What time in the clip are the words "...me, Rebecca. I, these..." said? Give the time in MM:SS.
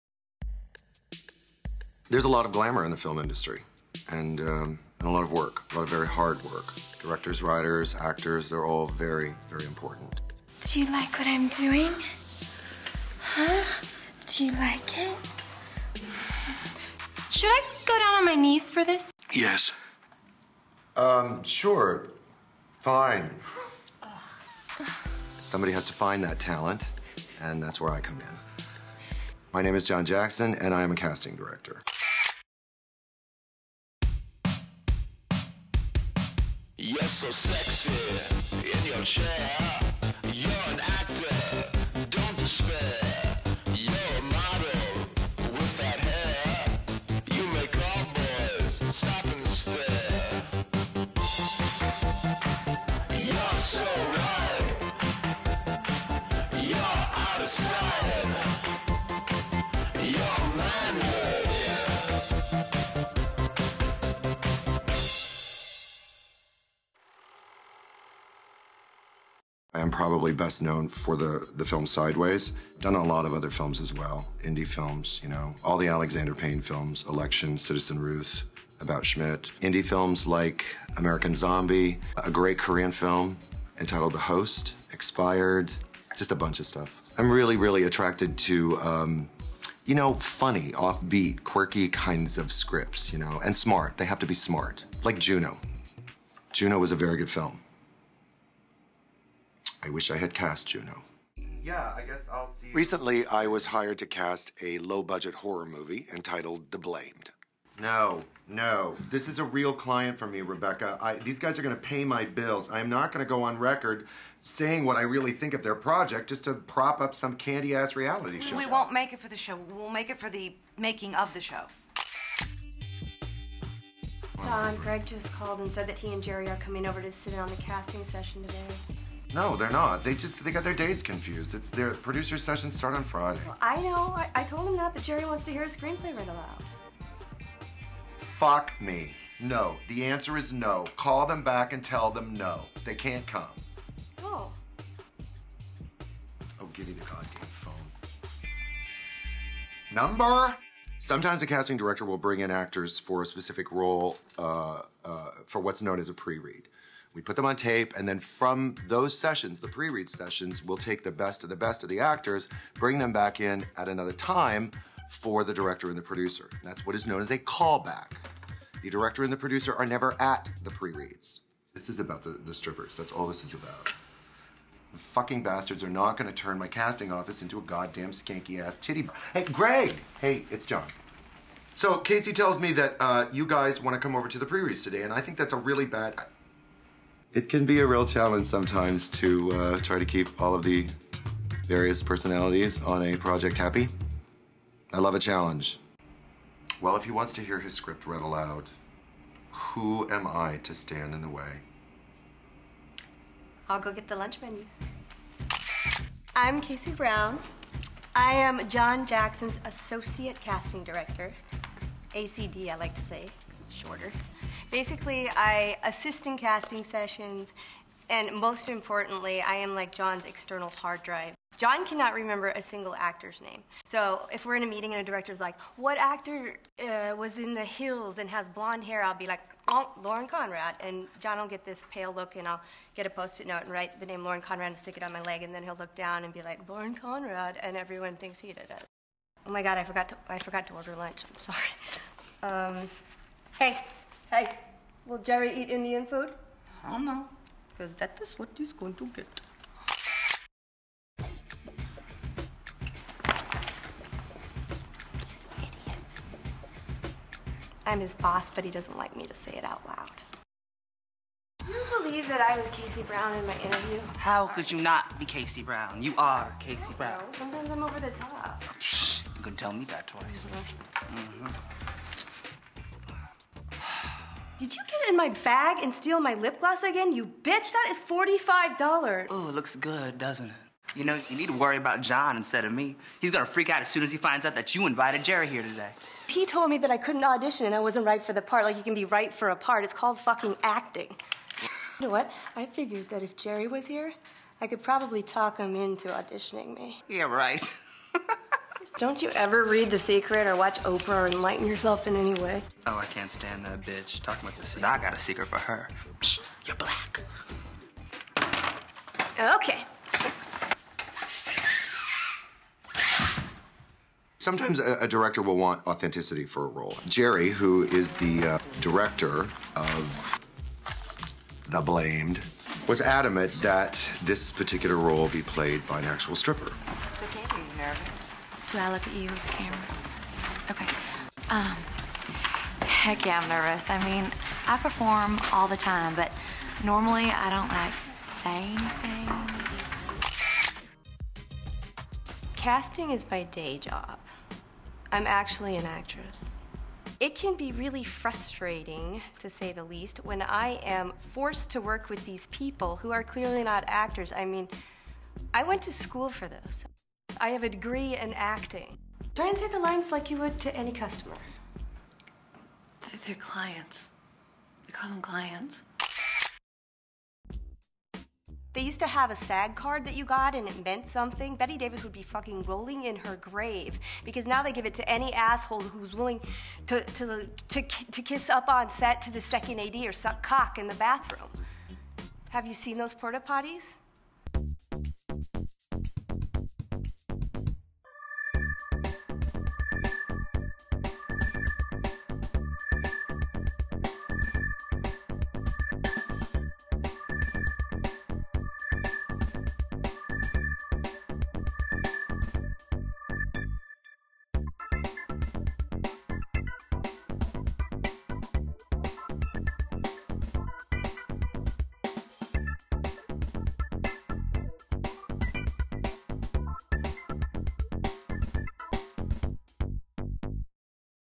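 01:50.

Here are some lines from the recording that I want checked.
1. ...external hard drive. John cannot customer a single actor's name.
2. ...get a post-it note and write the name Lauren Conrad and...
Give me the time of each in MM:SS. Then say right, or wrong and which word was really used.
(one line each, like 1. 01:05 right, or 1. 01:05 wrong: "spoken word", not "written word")
1. 03:40 wrong: "remember", not "customer"
2. 03:52 right.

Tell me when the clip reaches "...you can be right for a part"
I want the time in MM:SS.
04:48.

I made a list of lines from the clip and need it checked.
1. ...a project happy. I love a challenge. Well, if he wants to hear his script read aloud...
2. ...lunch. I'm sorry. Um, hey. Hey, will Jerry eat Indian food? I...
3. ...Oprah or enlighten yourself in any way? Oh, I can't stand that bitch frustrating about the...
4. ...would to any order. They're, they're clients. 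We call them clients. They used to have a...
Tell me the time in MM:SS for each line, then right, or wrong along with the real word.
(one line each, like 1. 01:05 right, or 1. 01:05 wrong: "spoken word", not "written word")
1. 03:13 right
2. 04:00 right
3. 05:00 wrong: "talking", not "frustrating"
4. 06:00 wrong: "customer", not "order".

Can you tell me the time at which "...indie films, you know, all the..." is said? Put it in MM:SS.
01:14.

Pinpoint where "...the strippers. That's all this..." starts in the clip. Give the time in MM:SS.
02:52.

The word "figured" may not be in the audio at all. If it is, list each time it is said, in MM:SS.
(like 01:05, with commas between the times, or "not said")
04:52.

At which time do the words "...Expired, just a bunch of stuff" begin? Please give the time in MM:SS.
01:24.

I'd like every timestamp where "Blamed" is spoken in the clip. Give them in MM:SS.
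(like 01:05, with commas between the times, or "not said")
01:46, 05:21.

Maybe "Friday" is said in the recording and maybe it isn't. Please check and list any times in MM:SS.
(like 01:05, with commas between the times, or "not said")
02:13.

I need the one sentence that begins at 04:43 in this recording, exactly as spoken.
He's gonna freak out as soon as he finds out that you invited Jerry here today.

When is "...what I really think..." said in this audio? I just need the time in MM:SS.
01:54.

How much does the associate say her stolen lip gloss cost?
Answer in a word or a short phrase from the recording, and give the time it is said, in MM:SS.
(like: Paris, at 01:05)
$45, at 04:37.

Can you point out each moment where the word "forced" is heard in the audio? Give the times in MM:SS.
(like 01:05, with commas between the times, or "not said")
05:51.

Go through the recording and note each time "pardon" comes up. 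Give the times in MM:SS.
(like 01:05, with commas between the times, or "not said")
not said.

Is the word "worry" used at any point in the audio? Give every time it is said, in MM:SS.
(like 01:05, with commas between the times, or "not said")
04:41.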